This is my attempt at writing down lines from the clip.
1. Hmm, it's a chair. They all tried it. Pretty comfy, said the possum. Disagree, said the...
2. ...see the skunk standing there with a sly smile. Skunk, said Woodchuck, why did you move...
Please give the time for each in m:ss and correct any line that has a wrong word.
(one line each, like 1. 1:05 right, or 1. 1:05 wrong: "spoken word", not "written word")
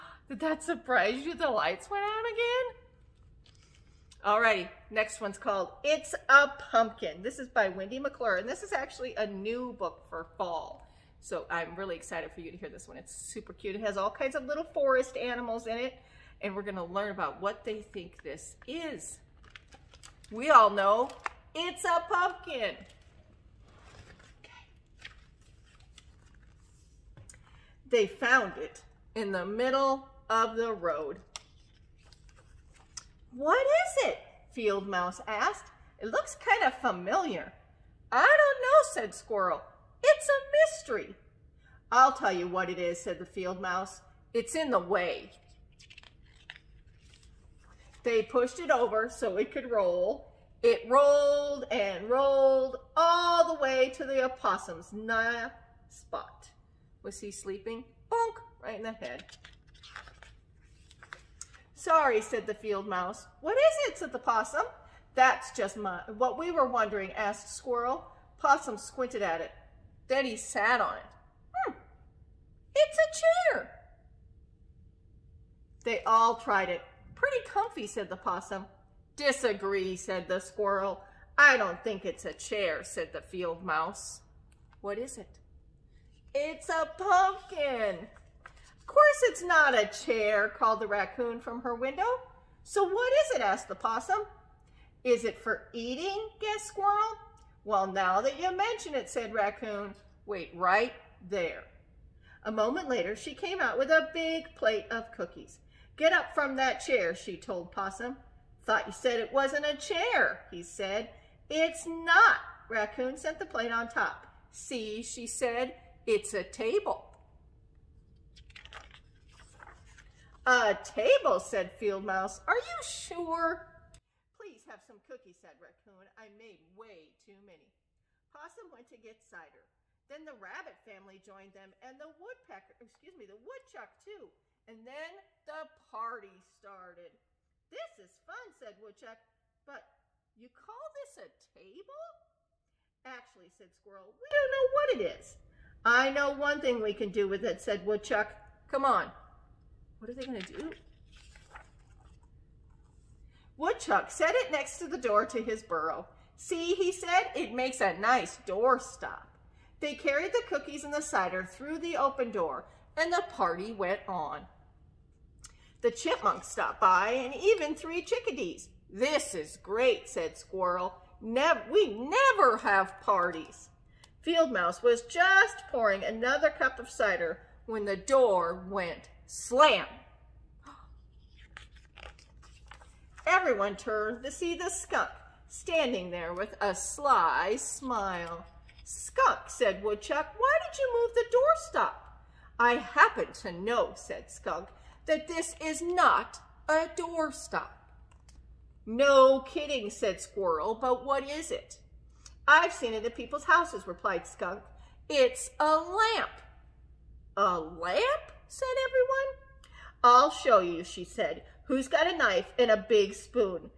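1. 1:11 right
2. 3:04 right.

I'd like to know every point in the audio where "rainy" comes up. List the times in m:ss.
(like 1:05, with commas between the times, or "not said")
not said.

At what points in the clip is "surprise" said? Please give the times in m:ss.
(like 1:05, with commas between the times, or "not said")
0:00.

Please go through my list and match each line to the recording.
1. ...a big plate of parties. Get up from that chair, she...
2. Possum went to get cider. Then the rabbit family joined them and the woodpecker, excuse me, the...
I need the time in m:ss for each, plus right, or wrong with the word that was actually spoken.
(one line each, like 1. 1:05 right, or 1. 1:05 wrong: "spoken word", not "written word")
1. 1:43 wrong: "cookies", not "parties"
2. 2:08 right.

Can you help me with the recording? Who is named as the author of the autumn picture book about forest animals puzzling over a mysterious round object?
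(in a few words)
Wendy McClure.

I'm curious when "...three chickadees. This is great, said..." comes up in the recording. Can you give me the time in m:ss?
2:47.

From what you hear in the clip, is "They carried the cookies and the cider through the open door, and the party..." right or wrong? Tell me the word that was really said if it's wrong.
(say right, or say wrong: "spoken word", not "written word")
right.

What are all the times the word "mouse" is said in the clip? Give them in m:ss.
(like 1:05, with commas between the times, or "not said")
0:34, 0:43, 1:02, 1:23, 2:02, 2:54.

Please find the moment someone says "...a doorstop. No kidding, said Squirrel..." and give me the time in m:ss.
3:16.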